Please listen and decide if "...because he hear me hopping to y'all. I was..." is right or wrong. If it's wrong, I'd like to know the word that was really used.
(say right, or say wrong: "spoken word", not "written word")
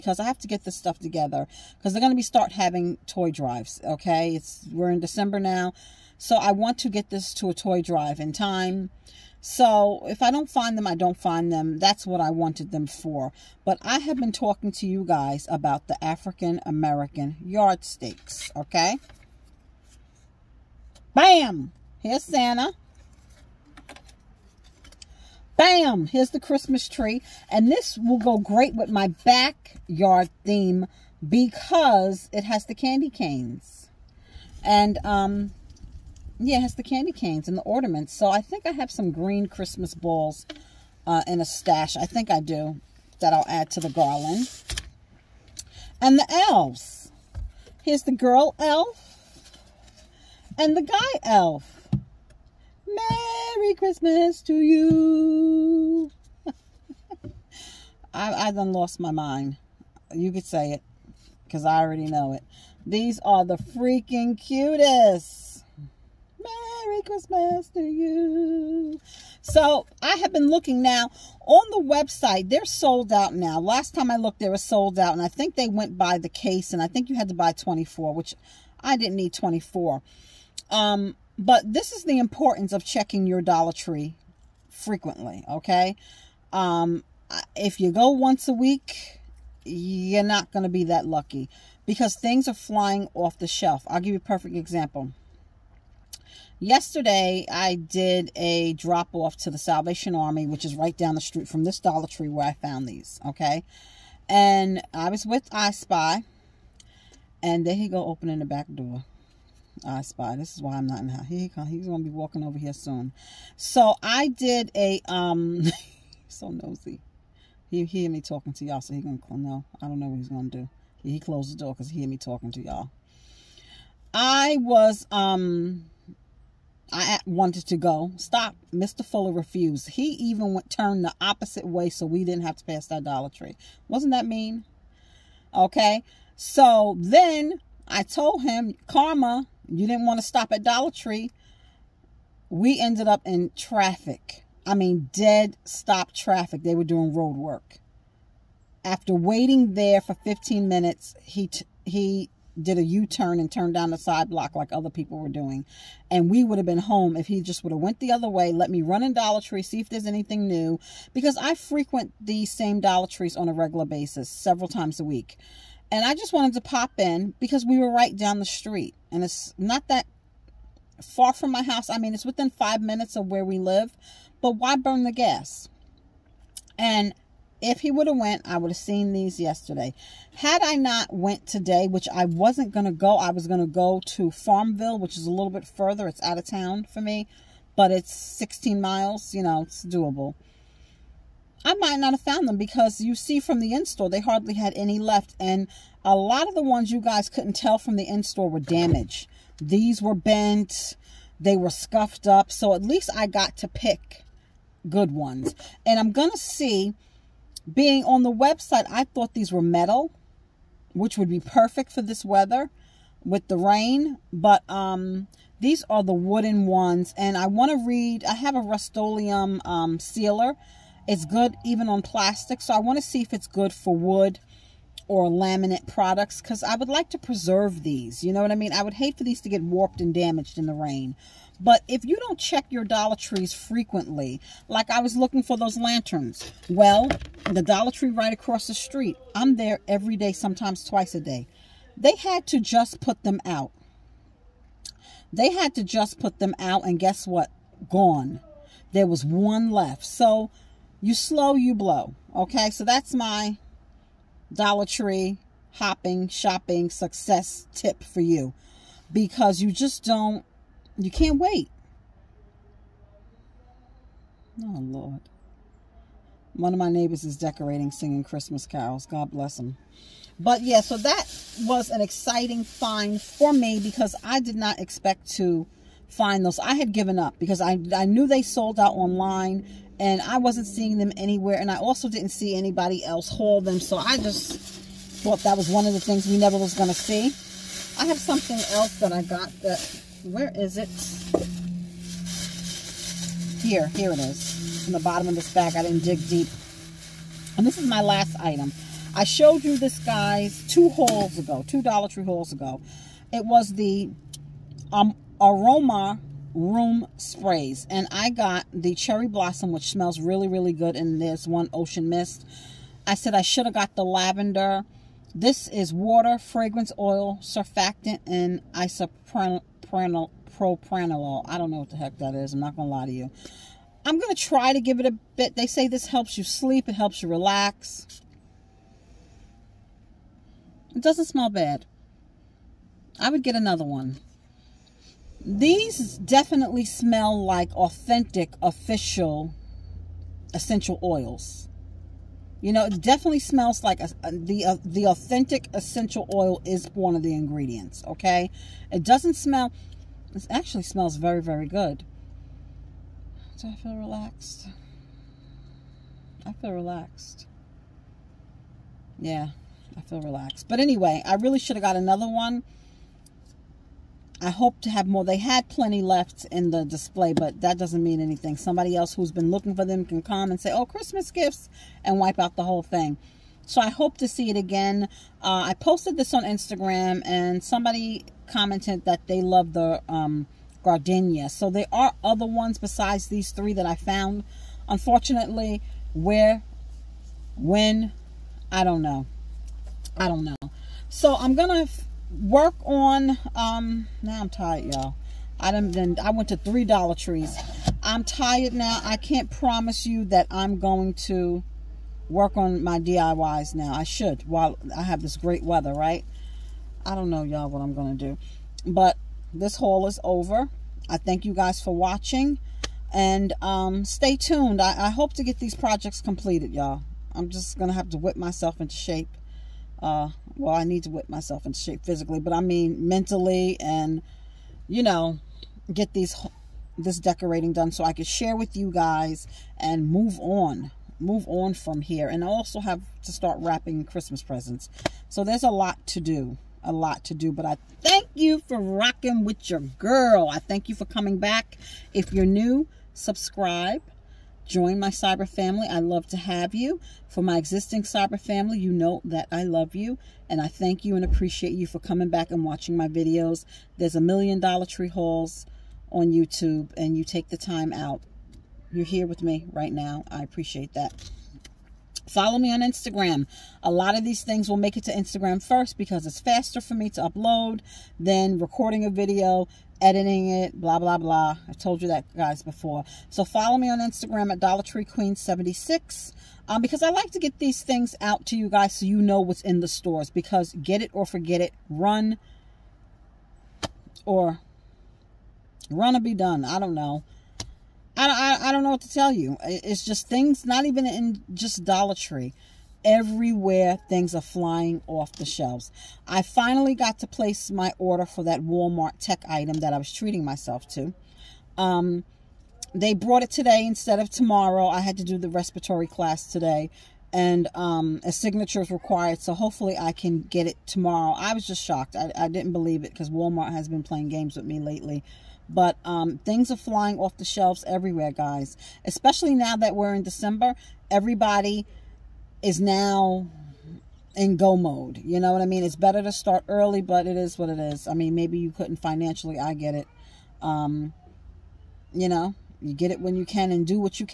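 wrong: "talking", not "hopping".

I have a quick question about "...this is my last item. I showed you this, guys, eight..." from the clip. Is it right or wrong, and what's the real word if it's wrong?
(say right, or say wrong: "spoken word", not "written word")
wrong: "two", not "eight".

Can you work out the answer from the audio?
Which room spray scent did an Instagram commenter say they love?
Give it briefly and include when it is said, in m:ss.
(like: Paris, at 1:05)
gardenia, at 6:20.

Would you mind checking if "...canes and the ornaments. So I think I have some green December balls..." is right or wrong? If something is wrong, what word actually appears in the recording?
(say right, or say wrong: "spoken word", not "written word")
wrong: "Christmas", not "December".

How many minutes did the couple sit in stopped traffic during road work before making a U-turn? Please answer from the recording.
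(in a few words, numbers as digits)
15.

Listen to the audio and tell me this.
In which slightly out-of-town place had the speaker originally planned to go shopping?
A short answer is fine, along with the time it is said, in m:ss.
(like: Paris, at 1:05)
Farmville, at 3:04.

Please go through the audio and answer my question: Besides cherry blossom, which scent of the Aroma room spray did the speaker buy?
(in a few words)
ocean mist.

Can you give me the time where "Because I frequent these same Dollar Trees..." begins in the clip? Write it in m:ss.
2:41.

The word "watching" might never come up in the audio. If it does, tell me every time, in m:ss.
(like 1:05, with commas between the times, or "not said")
6:51, 7:32.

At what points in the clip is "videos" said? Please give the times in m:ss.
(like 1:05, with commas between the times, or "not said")
7:33, 7:49.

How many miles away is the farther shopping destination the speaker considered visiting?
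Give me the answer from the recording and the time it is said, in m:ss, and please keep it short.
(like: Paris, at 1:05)
16, at 3:08.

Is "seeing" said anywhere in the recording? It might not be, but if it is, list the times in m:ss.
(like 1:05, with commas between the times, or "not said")
4:40.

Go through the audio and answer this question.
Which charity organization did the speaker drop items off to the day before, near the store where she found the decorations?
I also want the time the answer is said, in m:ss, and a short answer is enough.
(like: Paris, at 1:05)
Salvation Army, at 1:39.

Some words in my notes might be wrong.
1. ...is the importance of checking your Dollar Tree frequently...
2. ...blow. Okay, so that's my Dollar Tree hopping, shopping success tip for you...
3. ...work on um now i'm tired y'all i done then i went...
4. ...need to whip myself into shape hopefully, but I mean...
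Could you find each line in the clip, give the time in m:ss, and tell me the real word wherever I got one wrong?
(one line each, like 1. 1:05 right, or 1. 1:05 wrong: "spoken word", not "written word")
1. 1:21 right
2. 4:11 right
3. 6:32 right
4. 7:00 wrong: "physically", not "hopefully".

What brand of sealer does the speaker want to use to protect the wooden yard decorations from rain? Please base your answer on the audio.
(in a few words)
Rust-Oleum.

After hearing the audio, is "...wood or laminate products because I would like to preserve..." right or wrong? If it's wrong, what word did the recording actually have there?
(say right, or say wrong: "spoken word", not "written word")
right.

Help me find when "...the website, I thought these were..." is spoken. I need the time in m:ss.
3:28.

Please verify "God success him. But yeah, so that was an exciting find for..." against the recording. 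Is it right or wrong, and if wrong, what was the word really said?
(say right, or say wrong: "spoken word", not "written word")
wrong: "bless", not "success".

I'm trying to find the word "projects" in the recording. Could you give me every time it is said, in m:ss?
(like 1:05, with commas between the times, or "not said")
6:55.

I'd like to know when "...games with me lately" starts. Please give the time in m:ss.
8:34.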